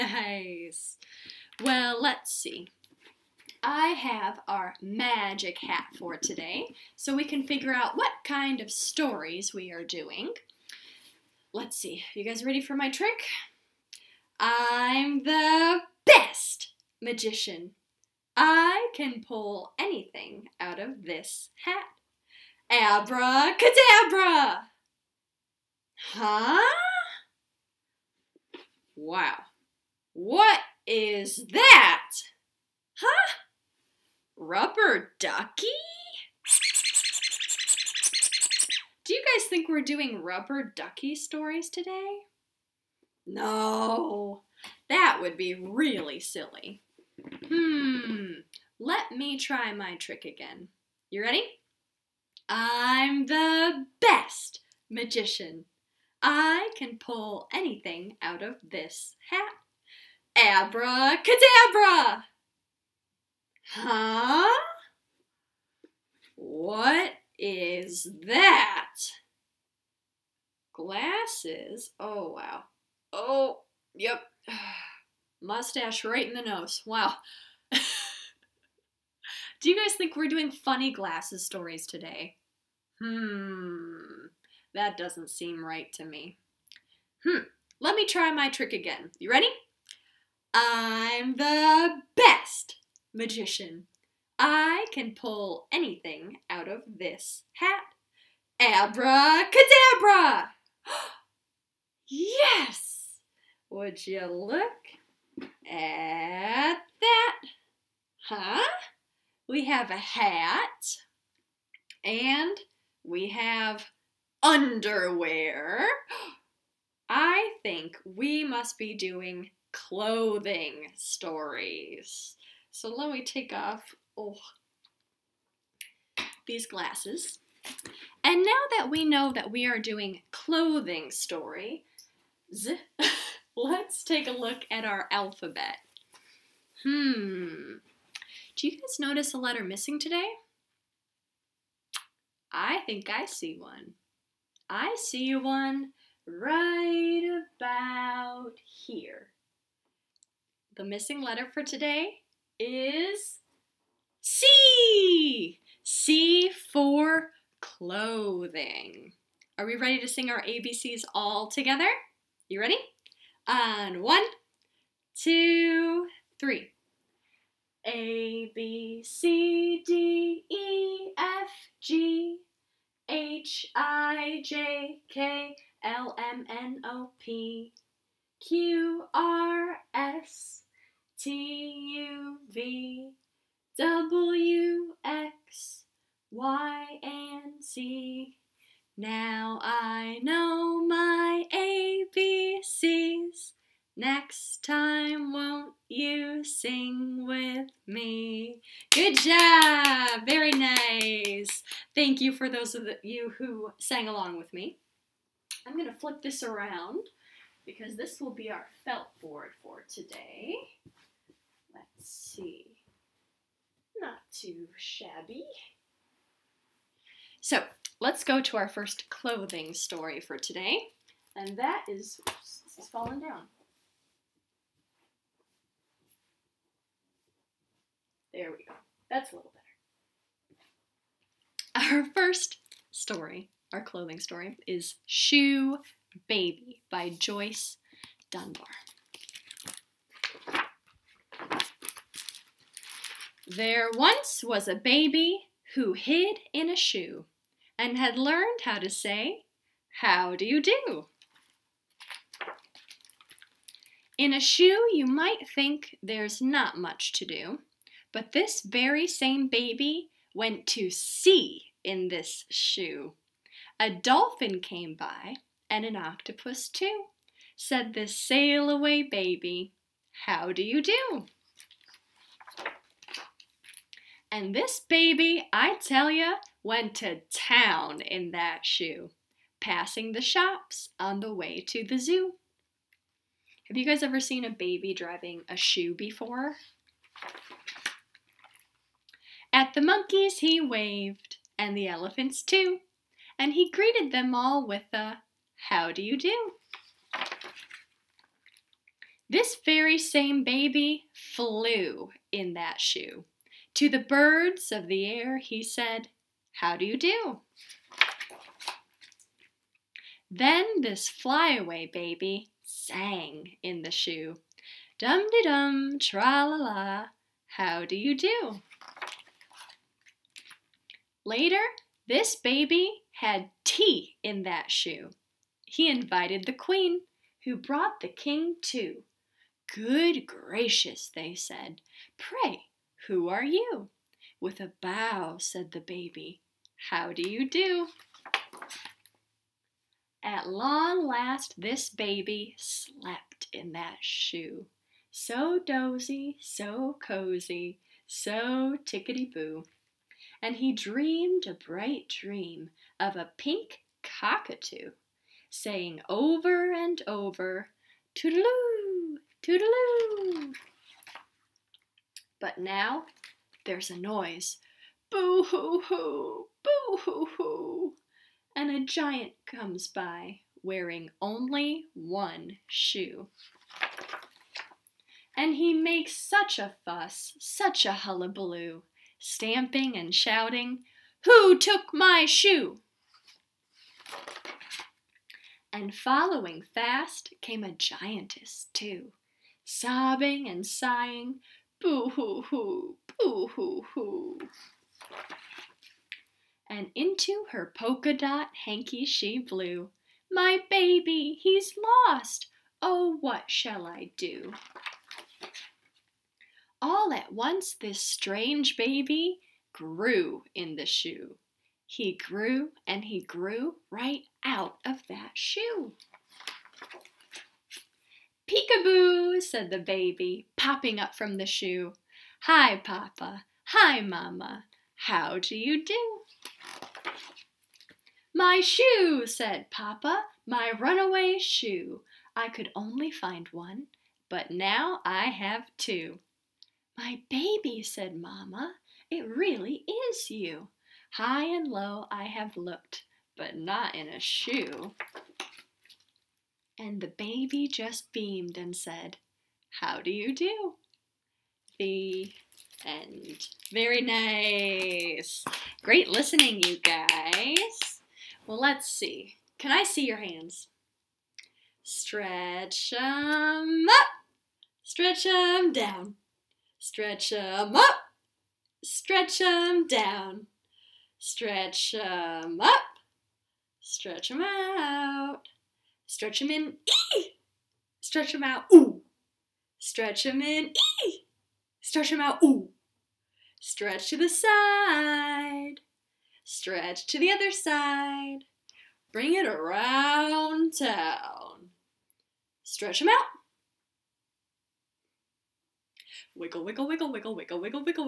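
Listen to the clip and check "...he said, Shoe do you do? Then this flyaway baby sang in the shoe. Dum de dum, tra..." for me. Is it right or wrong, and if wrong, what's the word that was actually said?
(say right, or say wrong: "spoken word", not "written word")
wrong: "How", not "Shoe".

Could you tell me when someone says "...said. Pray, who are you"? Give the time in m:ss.
5:31.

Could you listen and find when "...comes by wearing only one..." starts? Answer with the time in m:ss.
6:09.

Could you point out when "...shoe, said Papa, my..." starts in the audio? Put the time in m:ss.
7:08.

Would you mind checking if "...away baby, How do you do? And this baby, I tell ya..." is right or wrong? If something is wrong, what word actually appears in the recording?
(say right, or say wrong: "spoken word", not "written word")
right.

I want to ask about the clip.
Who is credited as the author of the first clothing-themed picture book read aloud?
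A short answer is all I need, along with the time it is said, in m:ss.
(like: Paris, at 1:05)
Joyce Dunbar, at 3:57.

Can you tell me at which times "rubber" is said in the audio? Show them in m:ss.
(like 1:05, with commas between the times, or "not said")
0:34, 0:40.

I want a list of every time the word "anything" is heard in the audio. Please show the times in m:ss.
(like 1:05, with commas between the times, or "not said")
0:19, 0:57, 1:35.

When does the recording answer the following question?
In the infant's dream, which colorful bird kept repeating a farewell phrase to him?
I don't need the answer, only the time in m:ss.
5:53.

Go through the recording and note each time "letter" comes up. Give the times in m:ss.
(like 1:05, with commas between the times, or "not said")
2:19, 2:31.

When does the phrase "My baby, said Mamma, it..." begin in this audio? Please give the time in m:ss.
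7:16.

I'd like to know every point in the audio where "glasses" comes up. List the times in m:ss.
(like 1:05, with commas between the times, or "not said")
1:10, 1:20, 2:06.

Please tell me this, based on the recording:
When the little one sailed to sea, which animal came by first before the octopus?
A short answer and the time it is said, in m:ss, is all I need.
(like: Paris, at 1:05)
A dolphin, at 4:23.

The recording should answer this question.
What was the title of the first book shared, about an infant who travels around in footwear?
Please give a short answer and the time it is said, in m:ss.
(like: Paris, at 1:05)
Shoe Baby, at 3:55.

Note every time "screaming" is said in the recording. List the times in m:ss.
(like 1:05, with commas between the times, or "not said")
not said.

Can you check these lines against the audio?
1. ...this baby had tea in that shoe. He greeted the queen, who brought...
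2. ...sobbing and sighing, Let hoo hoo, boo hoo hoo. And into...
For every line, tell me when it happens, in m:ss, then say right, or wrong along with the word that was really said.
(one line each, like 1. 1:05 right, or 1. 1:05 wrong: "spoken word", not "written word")
1. 5:22 wrong: "invited", not "greeted"
2. 6:29 wrong: "Boo", not "Let".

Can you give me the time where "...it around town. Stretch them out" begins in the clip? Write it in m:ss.
8:09.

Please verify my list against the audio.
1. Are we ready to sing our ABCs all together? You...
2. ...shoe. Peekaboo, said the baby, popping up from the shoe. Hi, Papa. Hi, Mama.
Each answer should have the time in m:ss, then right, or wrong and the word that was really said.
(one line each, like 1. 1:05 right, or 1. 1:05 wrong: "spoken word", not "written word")
1. 2:39 right
2. 6:55 right.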